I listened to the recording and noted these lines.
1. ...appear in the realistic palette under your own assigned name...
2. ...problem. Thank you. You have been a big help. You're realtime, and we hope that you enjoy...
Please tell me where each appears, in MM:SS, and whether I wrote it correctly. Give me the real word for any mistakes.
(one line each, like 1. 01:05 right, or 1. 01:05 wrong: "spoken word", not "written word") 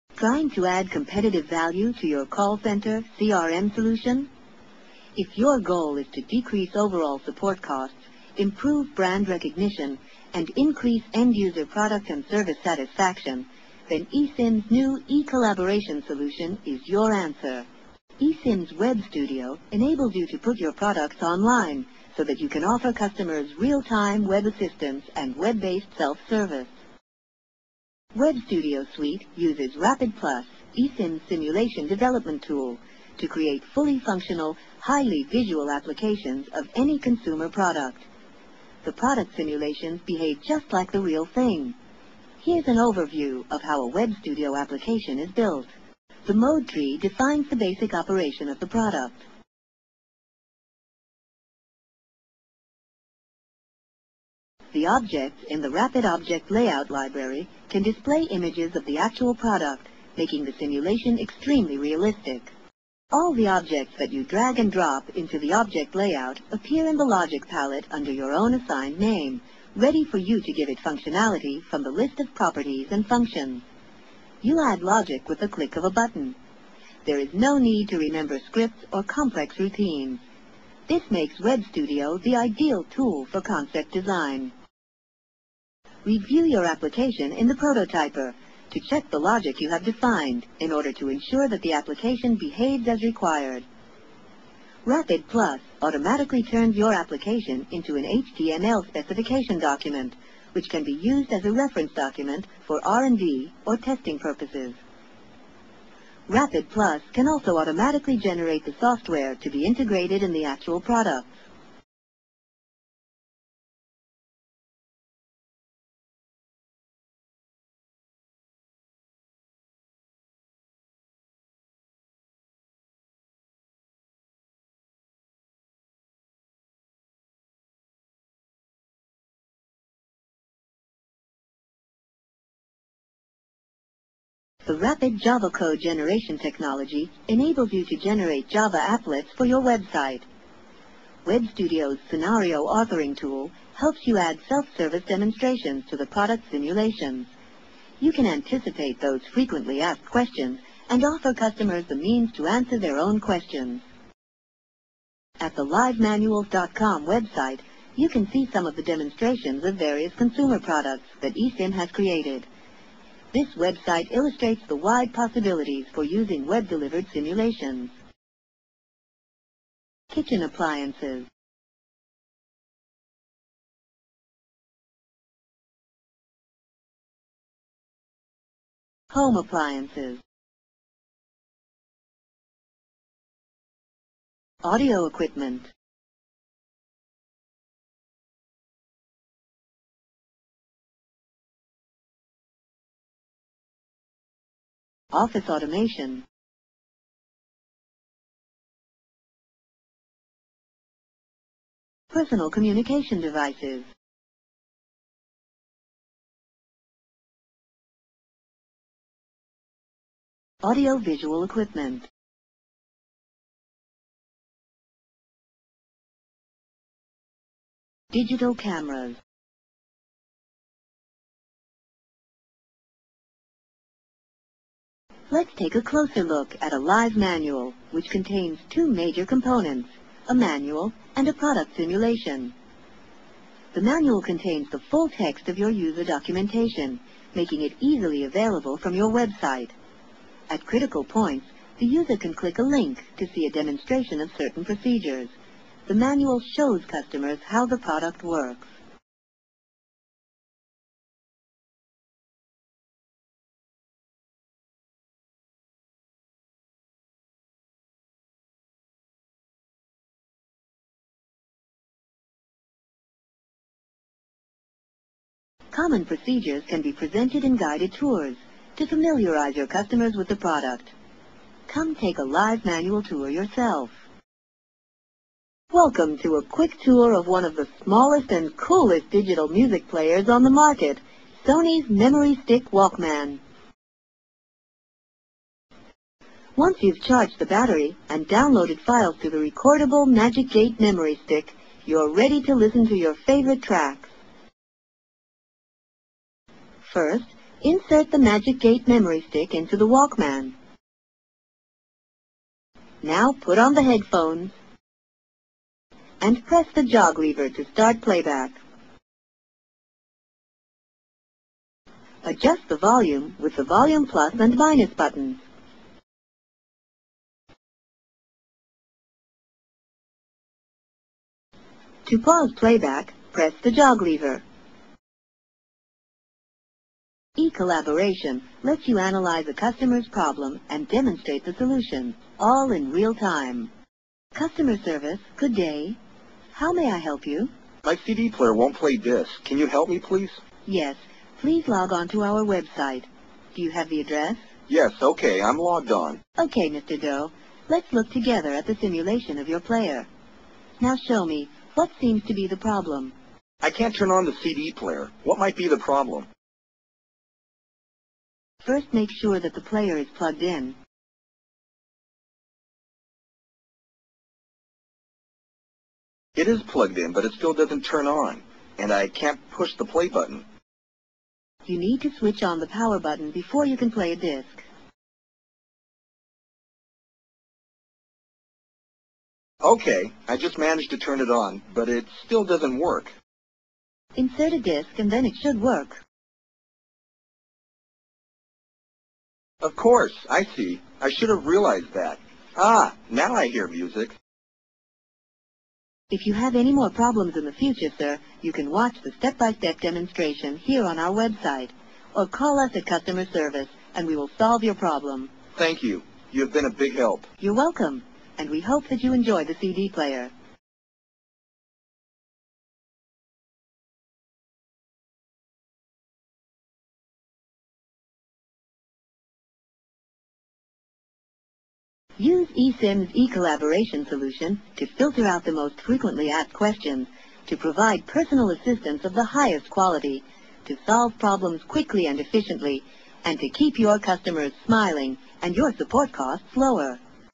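1. 01:06 wrong: "logic", not "realistic"
2. 06:44 wrong: "welcome", not "realtime".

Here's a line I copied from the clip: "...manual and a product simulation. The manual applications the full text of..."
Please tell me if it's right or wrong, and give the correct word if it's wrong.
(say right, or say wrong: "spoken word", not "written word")
wrong: "contains", not "applications".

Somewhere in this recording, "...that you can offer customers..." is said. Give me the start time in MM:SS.
00:22.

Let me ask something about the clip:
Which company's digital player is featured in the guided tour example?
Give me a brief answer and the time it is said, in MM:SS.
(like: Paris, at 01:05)
Sony, at 04:41.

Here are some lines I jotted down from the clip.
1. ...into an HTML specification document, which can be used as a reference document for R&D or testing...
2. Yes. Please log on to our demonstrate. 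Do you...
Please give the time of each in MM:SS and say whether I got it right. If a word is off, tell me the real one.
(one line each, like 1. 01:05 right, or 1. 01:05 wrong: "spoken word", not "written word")
1. 01:37 right
2. 05:40 wrong: "website", not "demonstrate".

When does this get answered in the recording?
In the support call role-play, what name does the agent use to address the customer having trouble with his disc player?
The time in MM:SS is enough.
05:46.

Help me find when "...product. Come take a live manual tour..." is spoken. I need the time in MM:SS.
04:30.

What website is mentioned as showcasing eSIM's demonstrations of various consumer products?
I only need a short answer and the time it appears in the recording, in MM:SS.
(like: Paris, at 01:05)
livemanuals.com, at 02:35.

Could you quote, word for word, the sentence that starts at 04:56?
First, insert the Magic Gate memory stick into the Walkman.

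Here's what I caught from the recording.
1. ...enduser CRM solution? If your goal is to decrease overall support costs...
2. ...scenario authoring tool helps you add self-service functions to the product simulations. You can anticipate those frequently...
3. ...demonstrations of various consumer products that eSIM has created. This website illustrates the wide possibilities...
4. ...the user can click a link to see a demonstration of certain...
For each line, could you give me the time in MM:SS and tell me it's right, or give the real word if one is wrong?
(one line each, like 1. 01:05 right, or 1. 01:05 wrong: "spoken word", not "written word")
1. 00:02 wrong: "center", not "enduser"
2. 02:22 wrong: "demonstrations", not "functions"
3. 02:38 right
4. 04:01 right.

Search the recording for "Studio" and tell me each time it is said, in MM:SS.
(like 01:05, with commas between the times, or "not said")
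00:19, 00:28, 00:44, 01:21, 02:21.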